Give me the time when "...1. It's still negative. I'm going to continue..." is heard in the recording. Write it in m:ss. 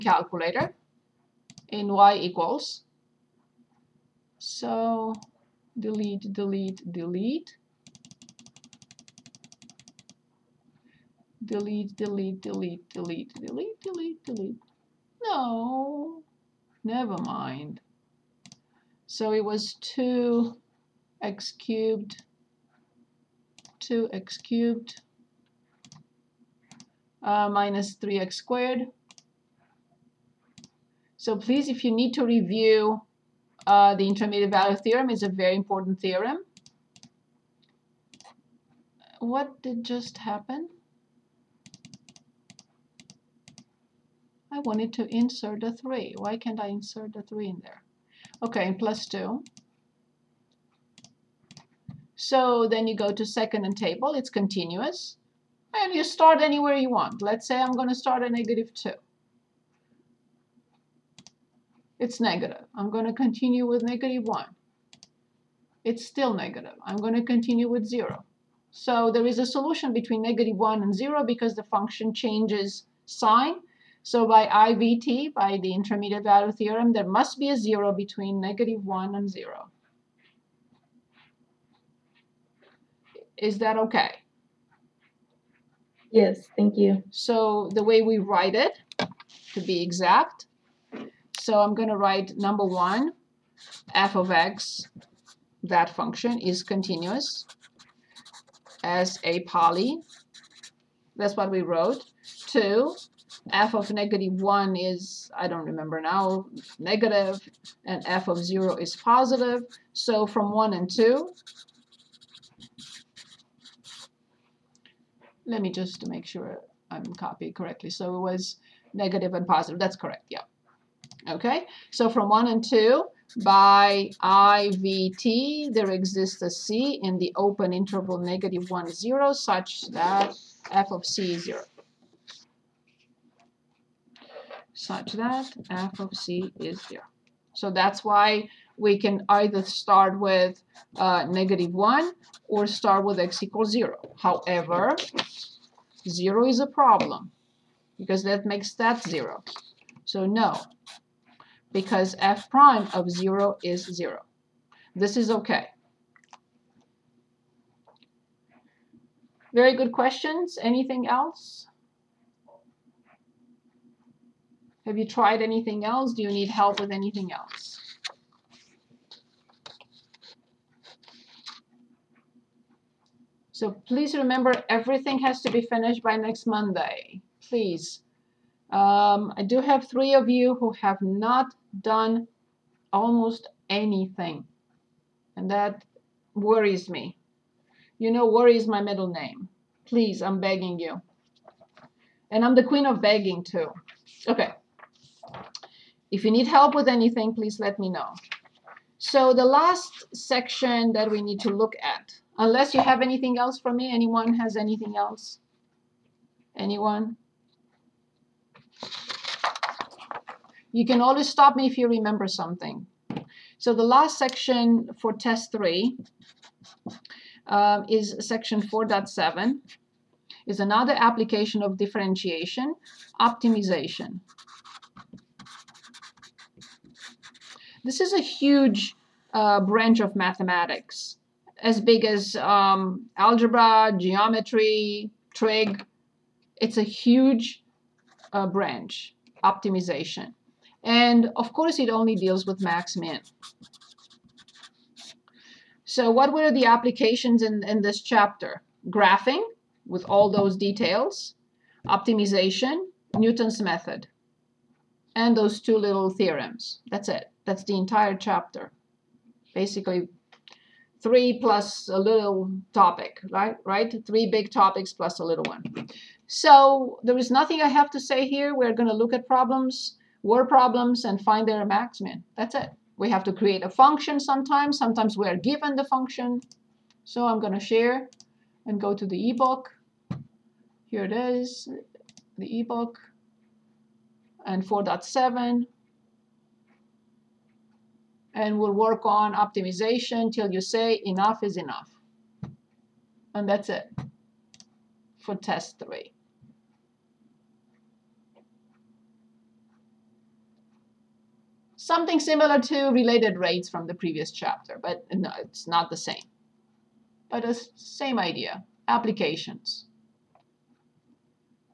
1:04.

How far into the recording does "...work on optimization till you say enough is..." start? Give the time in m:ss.
4:48.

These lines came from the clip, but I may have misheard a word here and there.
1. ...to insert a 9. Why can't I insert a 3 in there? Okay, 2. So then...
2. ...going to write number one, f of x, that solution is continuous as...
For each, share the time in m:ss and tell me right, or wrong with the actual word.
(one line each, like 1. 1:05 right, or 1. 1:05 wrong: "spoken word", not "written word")
1. 0:44 wrong: "3", not "9"
2. 1:31 wrong: "function", not "solution".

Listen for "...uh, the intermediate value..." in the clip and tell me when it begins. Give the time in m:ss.
0:33.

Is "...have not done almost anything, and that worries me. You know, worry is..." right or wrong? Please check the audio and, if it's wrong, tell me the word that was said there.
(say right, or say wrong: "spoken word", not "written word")
right.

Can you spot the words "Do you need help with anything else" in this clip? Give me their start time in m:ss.
2:46.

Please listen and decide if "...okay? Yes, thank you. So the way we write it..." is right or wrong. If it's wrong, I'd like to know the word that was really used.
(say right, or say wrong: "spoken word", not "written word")
right.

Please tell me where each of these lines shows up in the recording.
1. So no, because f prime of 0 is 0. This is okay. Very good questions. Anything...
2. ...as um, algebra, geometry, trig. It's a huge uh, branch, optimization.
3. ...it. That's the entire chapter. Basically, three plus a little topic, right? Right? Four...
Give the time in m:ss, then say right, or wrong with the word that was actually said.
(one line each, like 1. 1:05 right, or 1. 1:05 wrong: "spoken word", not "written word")
1. 2:30 right
2. 3:52 right
3. 4:17 wrong: "Three", not "Four".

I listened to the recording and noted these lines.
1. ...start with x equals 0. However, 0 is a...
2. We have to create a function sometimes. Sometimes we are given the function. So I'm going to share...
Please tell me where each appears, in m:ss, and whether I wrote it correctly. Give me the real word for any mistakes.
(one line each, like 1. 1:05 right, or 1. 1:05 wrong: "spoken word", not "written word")
1. 2:22 right
2. 4:32 right.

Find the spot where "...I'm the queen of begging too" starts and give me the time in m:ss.
3:12.